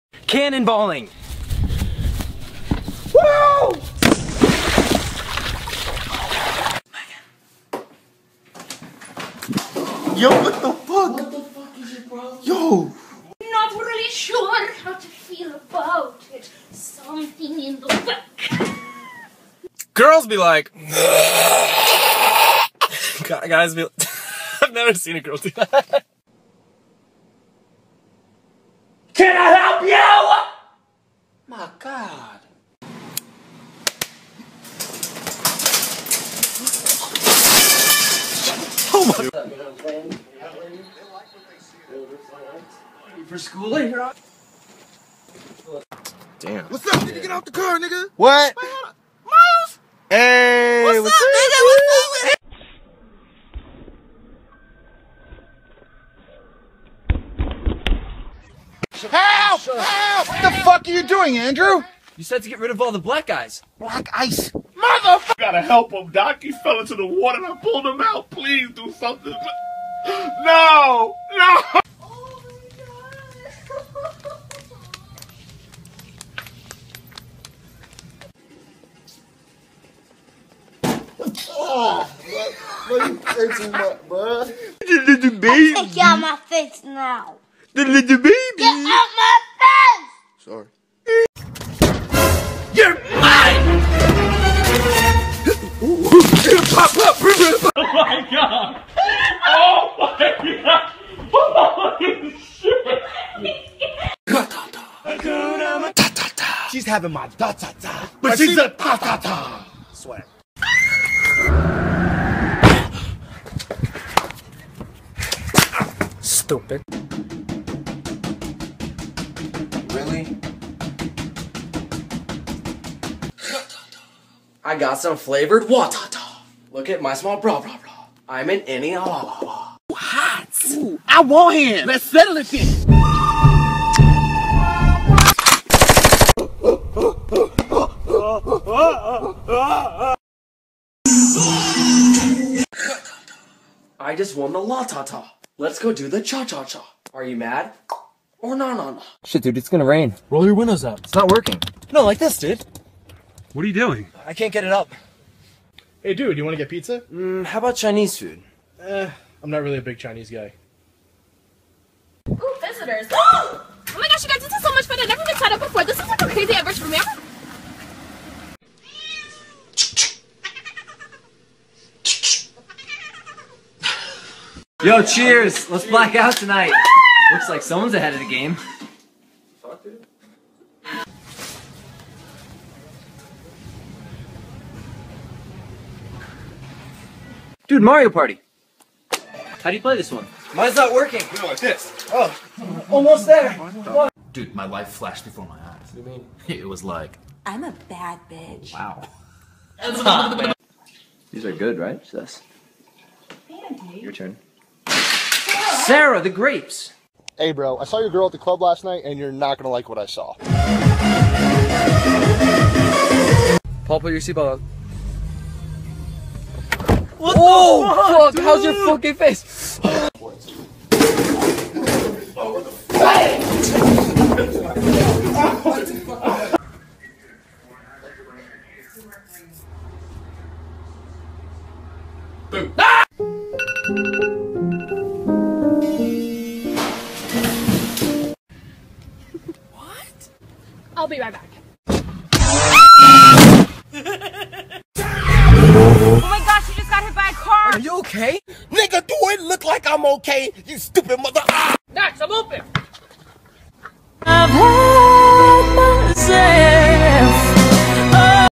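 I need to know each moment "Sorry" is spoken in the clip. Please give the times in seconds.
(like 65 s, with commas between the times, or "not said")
90 s.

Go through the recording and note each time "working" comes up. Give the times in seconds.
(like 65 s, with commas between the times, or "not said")
151 s, 190 s.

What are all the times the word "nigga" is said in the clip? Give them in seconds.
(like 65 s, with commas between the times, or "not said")
47 s, 248 s.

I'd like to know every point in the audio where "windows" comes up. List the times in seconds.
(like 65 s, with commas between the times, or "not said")
150 s.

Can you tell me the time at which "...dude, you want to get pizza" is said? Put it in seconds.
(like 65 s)
156 s.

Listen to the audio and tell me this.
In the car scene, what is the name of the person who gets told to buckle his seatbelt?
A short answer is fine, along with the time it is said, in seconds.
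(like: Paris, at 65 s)
Paul, at 213 s.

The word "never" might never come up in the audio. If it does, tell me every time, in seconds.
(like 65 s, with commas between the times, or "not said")
24 s, 165 s.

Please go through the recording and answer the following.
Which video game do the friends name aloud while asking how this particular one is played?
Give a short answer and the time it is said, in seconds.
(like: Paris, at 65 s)
Mario Party, at 187 s.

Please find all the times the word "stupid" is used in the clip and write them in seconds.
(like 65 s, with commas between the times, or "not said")
116 s, 250 s.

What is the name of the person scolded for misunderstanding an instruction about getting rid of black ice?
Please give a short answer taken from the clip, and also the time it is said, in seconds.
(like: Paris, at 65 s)
Andrew, at 61 s.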